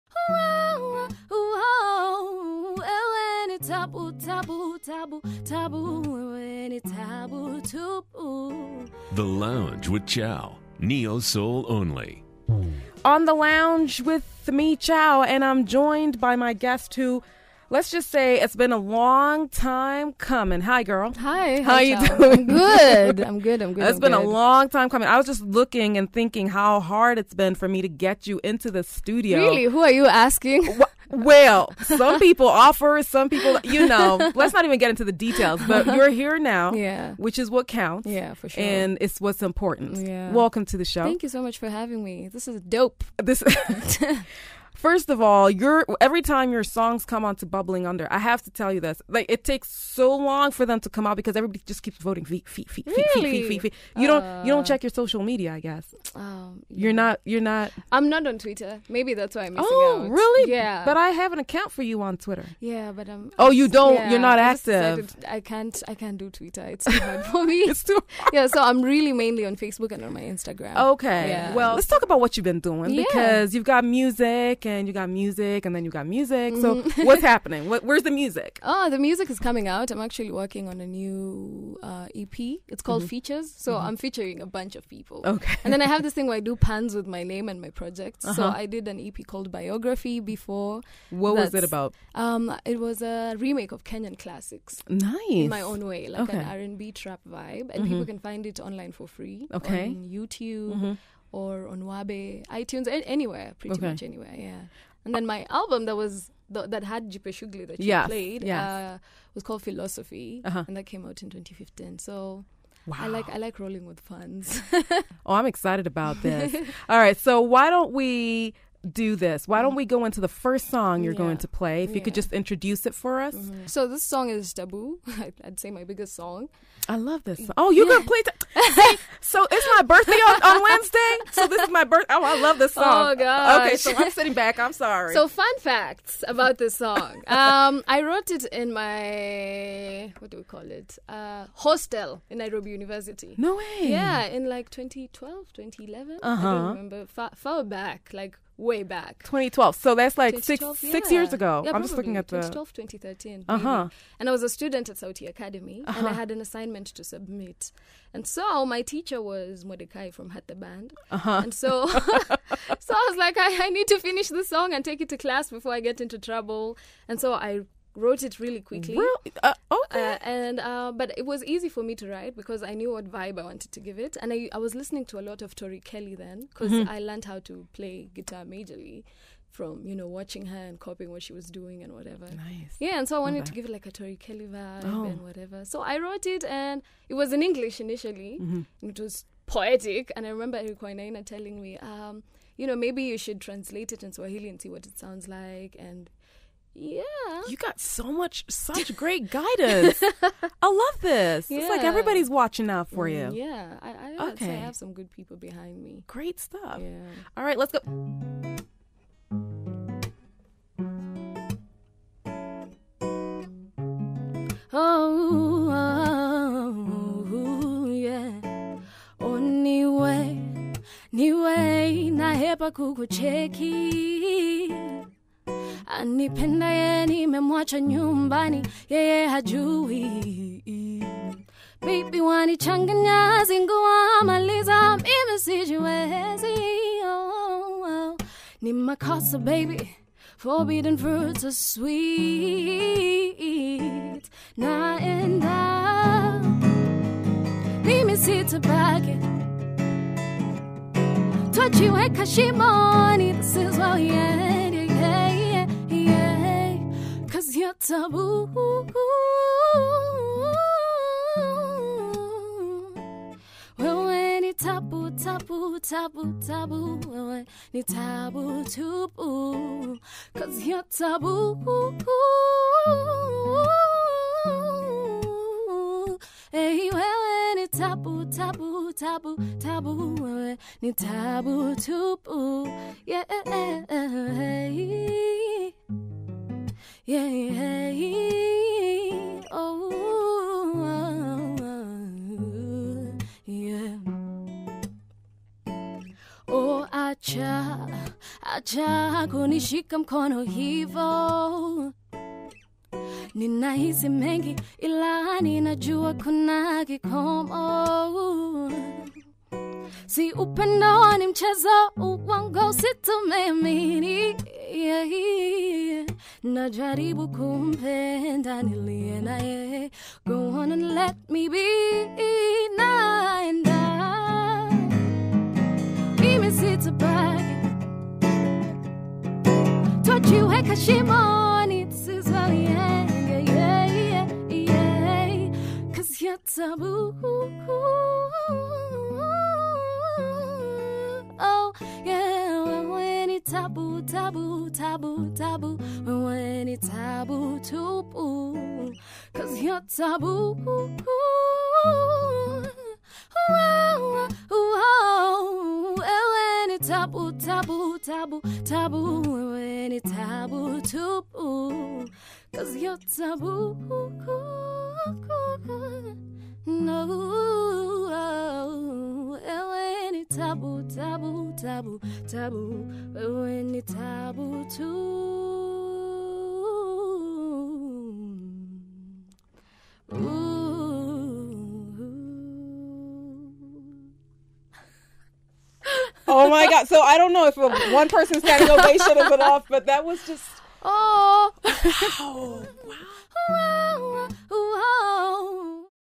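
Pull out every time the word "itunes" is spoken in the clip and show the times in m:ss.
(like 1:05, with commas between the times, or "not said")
1:42.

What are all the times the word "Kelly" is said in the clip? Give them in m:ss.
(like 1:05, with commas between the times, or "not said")
2:55, 3:04.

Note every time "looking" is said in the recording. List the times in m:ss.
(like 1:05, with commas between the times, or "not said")
0:25, 2:31.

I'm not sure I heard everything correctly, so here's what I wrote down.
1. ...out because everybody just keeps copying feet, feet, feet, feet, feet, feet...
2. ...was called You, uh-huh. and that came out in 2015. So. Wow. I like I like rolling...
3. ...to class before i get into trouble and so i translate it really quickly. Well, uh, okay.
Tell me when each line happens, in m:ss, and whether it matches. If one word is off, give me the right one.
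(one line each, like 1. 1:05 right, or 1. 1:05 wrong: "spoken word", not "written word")
1. 0:51 wrong: "voting", not "copying"
2. 1:49 wrong: "Phylosophy", not "You"
3. 2:45 wrong: "wrote", not "translate".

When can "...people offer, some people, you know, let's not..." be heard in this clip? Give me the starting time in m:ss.
0:32.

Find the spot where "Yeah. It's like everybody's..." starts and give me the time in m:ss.
3:21.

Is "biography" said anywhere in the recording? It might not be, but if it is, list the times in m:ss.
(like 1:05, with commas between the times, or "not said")
1:29.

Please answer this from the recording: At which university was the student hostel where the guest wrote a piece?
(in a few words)
Nairobi University.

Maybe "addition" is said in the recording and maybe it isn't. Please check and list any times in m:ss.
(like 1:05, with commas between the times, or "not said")
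not said.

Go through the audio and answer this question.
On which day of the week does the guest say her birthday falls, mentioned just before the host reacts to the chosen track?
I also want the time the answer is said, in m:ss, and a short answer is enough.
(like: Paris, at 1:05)
Wednesday, at 2:10.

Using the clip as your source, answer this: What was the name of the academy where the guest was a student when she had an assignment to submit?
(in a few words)
Sauti Academy.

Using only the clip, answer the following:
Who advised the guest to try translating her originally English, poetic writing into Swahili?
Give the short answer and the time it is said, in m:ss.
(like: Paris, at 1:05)
Eric Wainaina, at 3:10.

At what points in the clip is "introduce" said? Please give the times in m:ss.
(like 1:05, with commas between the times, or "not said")
2:02.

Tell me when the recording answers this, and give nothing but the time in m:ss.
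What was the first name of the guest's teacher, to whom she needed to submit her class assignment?
2:39.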